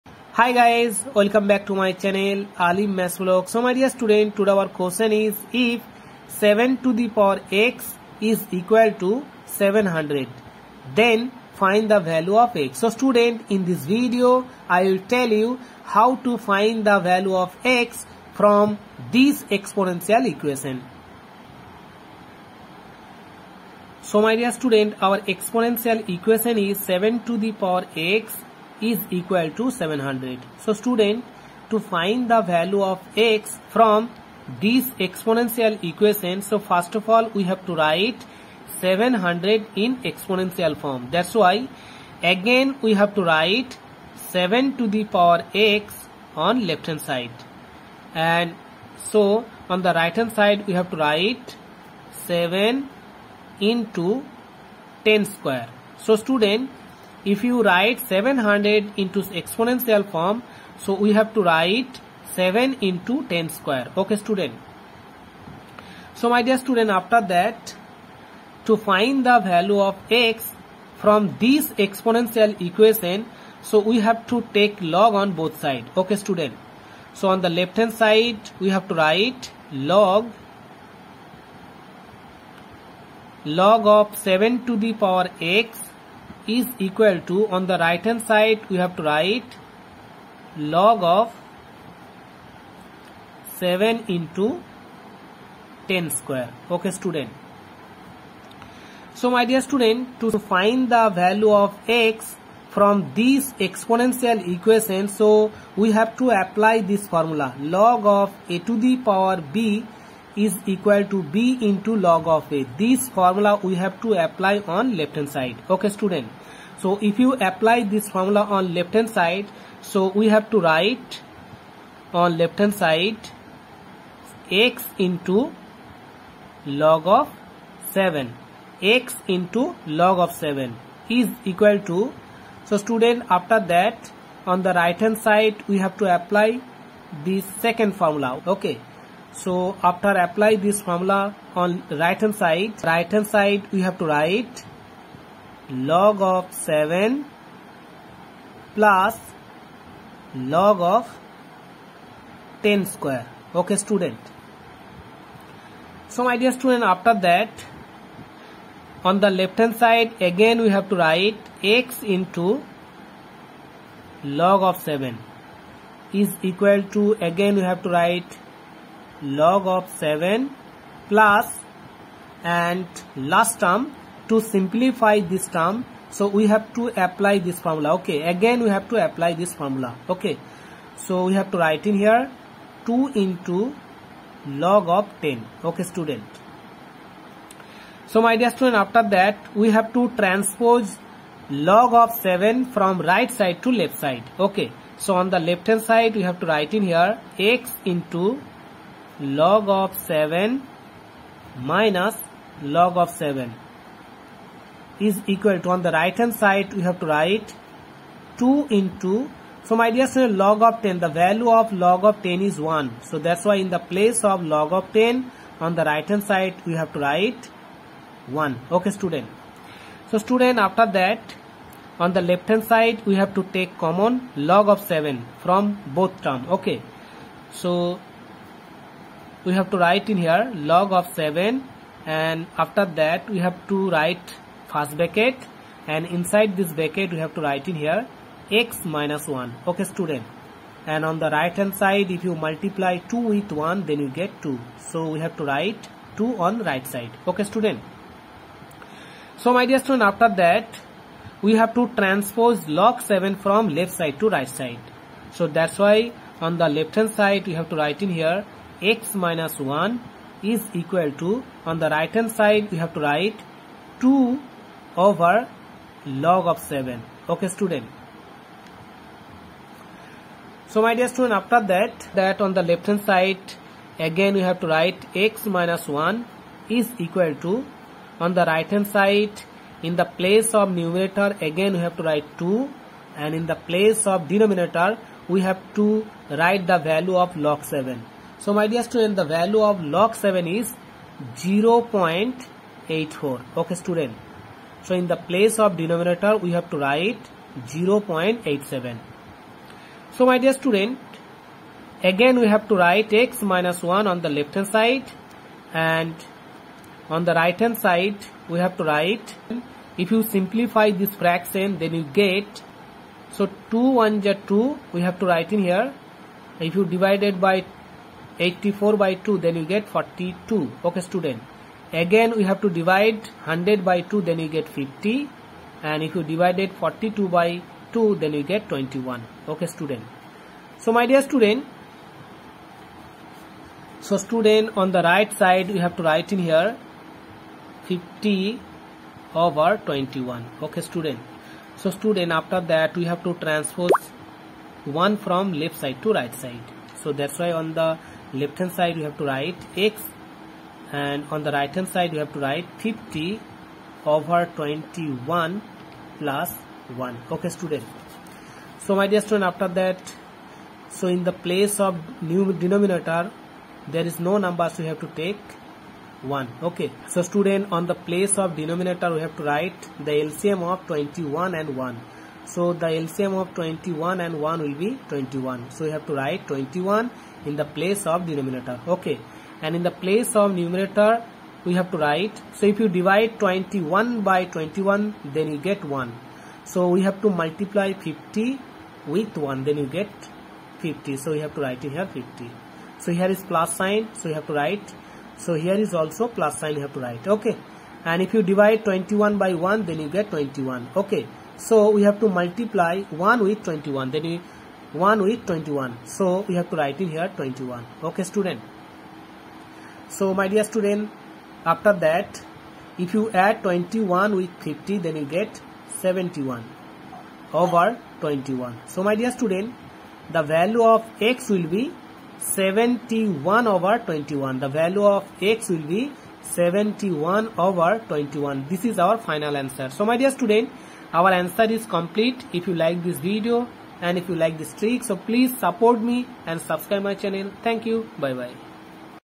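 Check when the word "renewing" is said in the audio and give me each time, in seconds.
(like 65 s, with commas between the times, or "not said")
not said.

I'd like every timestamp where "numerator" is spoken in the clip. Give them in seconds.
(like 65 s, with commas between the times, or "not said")
280 s, 380 s.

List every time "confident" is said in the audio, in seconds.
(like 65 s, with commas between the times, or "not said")
not said.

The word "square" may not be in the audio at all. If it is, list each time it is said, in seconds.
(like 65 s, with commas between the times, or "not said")
55 s, 63 s, 96 s, 152 s.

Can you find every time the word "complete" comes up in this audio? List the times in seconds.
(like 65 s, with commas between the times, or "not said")
431 s.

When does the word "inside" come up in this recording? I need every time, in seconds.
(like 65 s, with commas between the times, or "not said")
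236 s.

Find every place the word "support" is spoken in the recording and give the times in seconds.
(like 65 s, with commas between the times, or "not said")
435 s.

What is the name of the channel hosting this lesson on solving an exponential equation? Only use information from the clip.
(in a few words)
Alim Maths Blog.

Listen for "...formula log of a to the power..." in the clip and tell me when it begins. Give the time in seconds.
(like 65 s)
107 s.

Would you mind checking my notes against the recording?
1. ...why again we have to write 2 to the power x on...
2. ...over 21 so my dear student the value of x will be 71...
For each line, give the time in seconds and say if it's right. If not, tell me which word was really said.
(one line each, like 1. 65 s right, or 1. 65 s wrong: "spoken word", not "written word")
1. 41 s wrong: "7", not "2"
2. 417 s right.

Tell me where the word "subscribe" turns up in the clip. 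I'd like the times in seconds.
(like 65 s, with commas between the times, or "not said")
436 s.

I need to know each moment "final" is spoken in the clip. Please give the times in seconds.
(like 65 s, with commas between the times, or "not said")
429 s.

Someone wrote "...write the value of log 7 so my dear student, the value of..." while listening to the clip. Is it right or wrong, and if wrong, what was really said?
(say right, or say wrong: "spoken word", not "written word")
right.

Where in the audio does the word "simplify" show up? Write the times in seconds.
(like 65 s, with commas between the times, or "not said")
174 s, 310 s.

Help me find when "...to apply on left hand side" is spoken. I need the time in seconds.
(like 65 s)
114 s.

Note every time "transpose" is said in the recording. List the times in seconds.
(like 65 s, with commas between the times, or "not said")
190 s, 252 s, 343 s.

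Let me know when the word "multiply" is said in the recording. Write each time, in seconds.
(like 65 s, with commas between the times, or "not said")
242 s, 387 s, 402 s.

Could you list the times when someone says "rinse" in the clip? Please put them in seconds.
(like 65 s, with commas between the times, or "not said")
not said.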